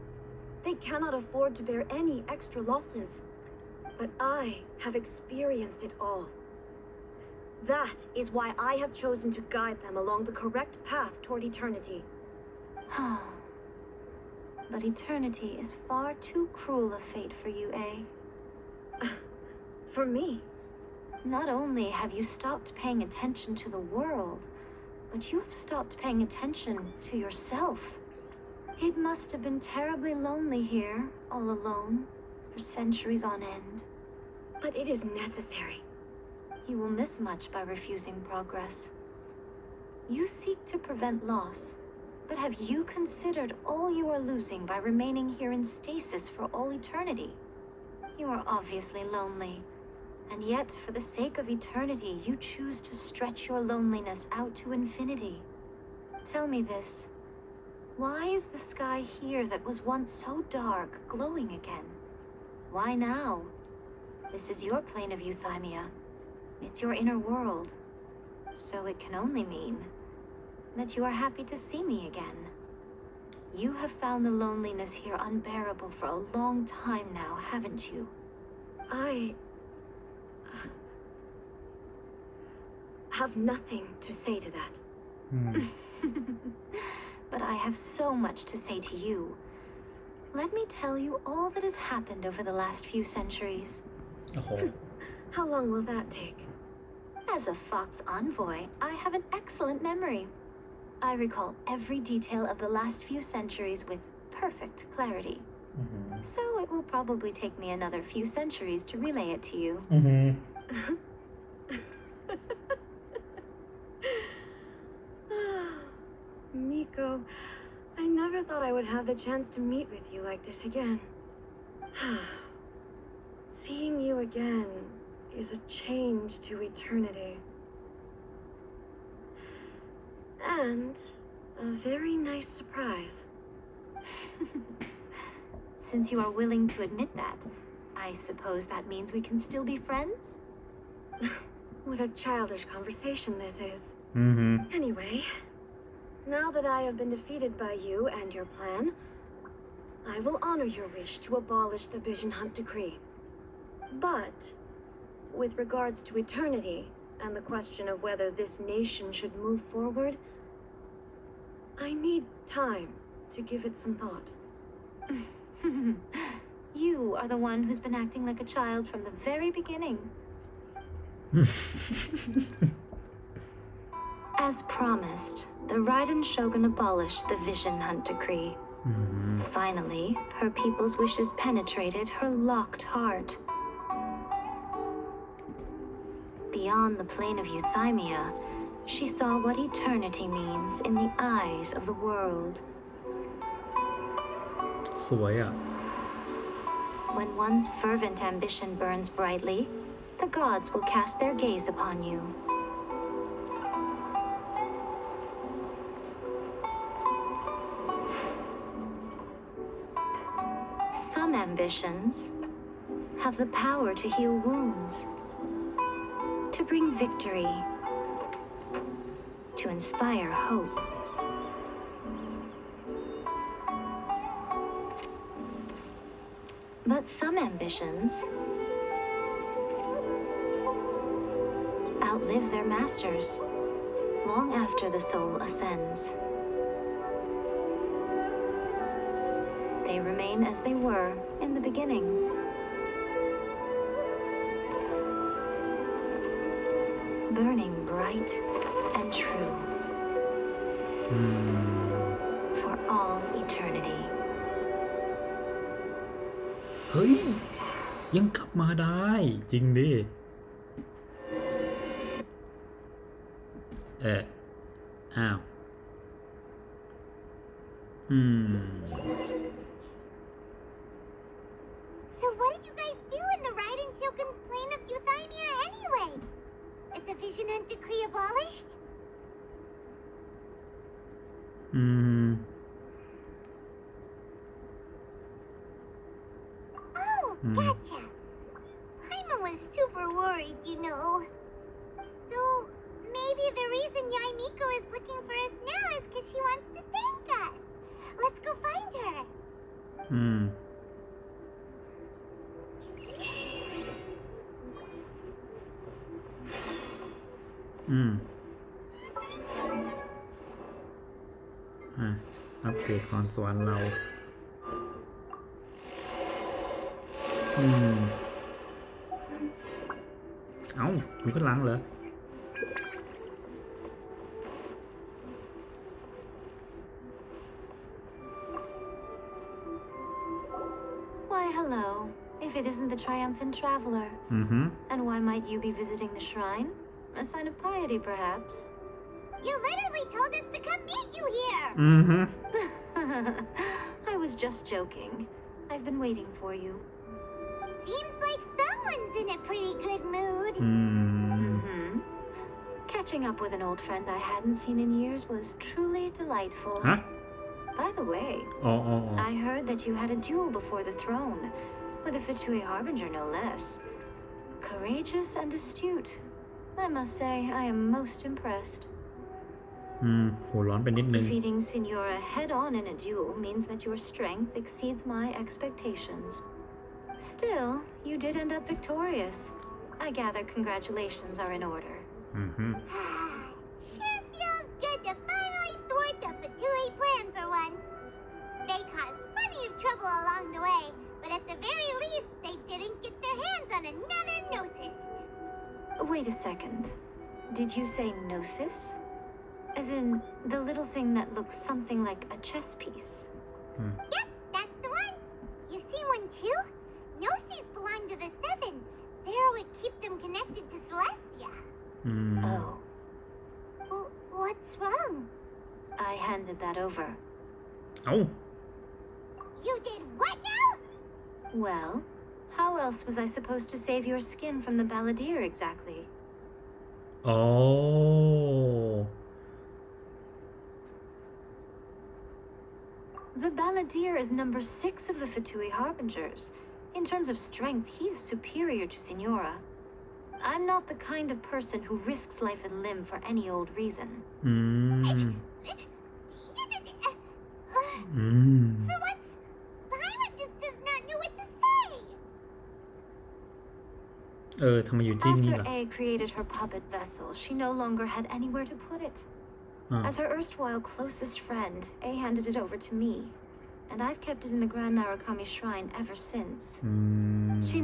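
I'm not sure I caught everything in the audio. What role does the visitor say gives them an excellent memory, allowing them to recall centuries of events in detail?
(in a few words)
Fox envoy.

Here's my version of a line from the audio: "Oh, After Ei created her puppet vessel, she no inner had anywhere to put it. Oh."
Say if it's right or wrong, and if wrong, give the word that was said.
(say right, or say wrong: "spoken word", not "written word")
wrong: "longer", not "inner".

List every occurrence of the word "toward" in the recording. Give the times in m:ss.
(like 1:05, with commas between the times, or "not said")
0:11.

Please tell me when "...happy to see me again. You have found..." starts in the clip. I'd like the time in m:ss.
1:11.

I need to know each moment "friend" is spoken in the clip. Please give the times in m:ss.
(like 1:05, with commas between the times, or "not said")
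2:19, 5:53, 7:41.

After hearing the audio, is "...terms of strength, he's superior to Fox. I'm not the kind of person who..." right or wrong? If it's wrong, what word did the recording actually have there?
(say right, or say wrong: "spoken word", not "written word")
wrong: "Signora", not "Fox".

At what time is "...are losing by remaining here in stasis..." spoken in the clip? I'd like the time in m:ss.
0:44.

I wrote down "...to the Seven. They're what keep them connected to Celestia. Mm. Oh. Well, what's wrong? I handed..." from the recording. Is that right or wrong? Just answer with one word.
right.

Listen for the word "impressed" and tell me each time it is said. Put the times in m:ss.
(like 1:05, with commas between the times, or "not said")
6:08.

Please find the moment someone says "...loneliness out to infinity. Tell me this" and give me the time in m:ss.
0:53.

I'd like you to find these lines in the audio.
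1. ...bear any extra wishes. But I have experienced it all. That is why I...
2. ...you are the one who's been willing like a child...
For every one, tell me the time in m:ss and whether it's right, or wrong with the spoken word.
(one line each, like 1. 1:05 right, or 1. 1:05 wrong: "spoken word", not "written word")
1. 0:01 wrong: "losses", not "wishes"
2. 2:46 wrong: "acting", not "willing".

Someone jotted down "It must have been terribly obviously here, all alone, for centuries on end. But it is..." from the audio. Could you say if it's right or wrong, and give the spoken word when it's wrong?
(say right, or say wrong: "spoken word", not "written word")
wrong: "lonely", not "obviously".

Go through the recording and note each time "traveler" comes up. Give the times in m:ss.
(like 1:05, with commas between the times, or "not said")
5:33.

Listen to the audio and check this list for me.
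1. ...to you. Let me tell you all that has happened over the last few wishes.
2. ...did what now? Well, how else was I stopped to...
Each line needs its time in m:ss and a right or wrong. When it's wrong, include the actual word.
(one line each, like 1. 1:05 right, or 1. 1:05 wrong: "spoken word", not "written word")
1. 1:28 wrong: "centuries", not "wishes"
2. 6:59 wrong: "supposed", not "stopped".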